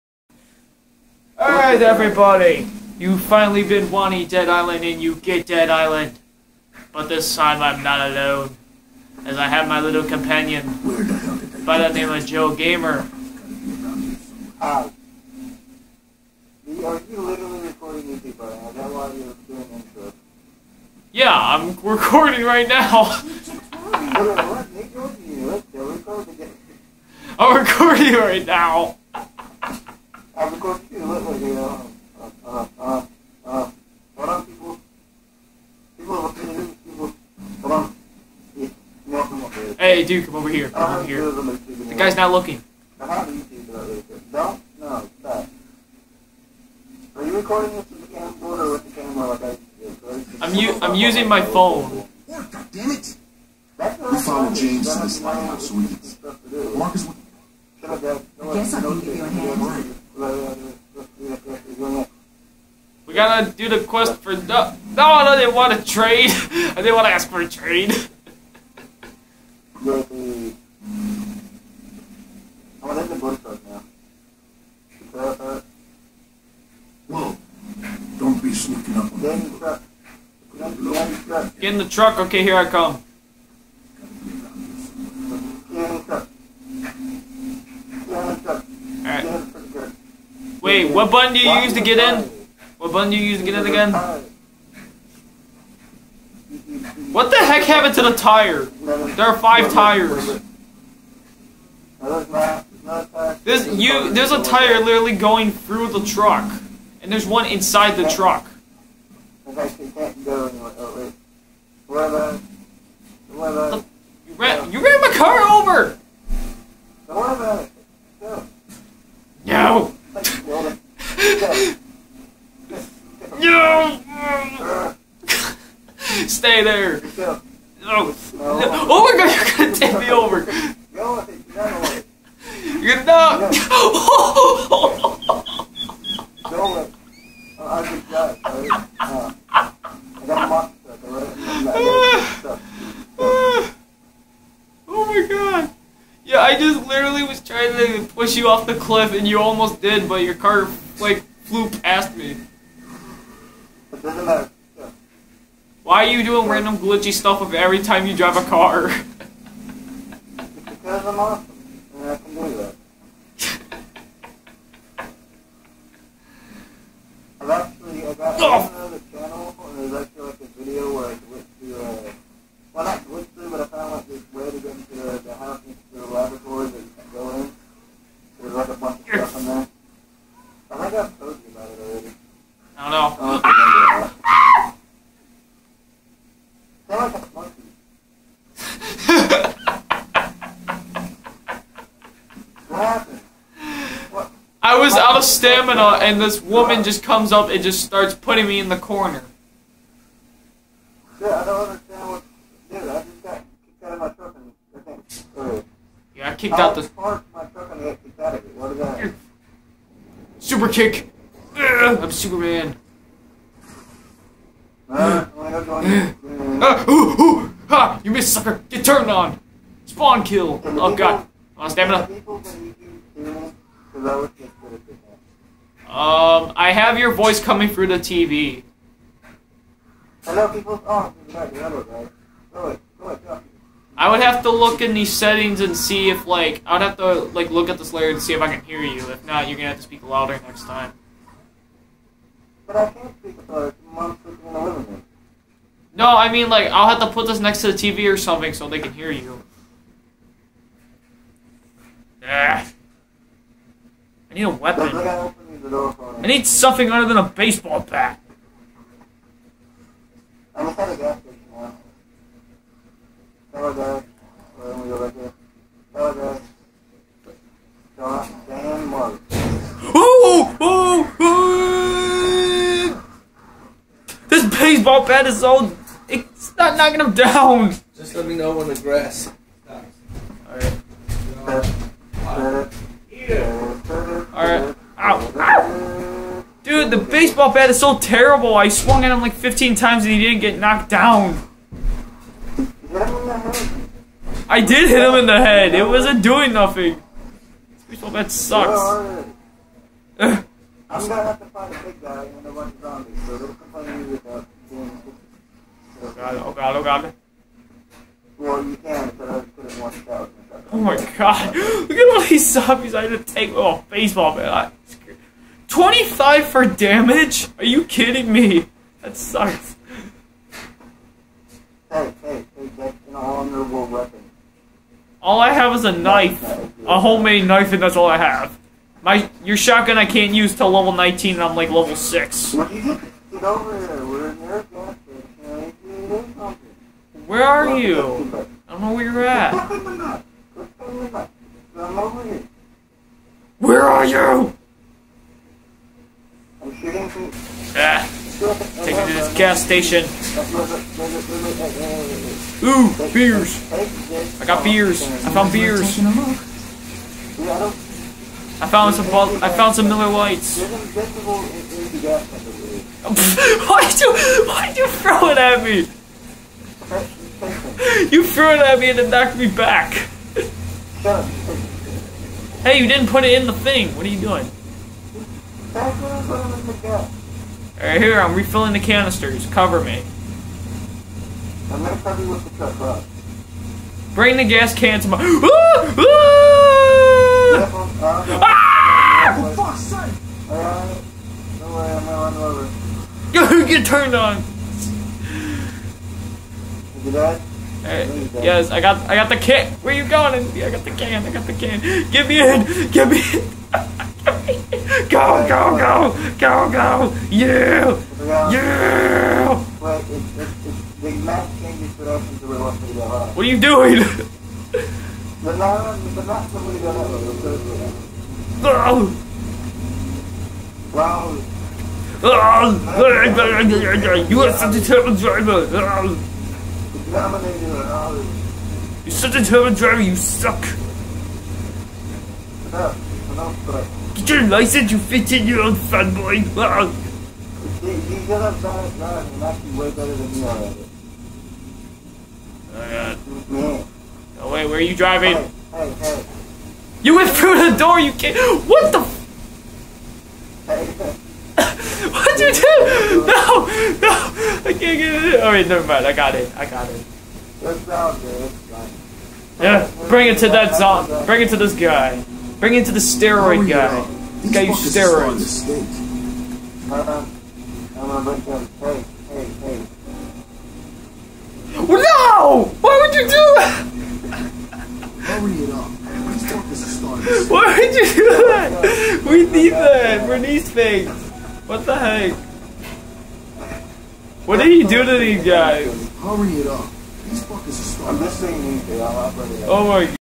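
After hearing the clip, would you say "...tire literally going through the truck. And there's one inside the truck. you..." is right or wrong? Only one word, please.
right.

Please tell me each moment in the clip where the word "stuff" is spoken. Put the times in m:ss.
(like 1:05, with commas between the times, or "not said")
2:37.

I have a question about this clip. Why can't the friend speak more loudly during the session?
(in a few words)
Mom's sleeping.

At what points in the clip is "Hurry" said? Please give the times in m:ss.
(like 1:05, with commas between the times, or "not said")
7:55, 8:06.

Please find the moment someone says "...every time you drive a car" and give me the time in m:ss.
2:37.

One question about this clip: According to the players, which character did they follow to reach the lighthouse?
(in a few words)
James.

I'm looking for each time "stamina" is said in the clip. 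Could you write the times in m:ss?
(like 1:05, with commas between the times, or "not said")
3:15, 3:41.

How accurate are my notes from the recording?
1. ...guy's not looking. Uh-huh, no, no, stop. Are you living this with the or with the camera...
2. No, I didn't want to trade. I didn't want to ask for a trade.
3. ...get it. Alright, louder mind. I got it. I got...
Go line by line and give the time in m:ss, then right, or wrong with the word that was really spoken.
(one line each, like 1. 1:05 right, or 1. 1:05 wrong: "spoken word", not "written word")
1. 0:41 wrong: "recording", not "living"
2. 1:04 right
3. 7:34 wrong: "never", not "louder".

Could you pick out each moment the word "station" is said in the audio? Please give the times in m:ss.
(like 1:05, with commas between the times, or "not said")
4:21, 5:49.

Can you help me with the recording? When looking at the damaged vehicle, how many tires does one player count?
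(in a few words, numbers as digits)
5.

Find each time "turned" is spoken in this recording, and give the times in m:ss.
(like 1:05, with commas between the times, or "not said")
3:38, 6:33.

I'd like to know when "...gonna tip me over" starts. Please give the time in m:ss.
2:09.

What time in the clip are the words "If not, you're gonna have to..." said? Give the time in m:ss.
3:59.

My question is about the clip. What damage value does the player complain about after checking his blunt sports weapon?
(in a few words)
25.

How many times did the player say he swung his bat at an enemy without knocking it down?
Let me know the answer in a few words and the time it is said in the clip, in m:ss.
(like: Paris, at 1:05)
15, at 4:49.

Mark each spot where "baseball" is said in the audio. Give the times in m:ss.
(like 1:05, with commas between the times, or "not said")
4:17, 4:34, 4:46, 4:57, 5:13.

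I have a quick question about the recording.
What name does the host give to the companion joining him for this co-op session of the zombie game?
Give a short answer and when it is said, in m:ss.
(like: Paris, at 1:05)
Joe Gamer, at 0:12.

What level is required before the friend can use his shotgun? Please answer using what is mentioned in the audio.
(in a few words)
19.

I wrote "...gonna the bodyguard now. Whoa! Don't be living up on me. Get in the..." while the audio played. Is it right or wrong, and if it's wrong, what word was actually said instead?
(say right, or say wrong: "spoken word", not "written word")
wrong: "sneaking", not "living".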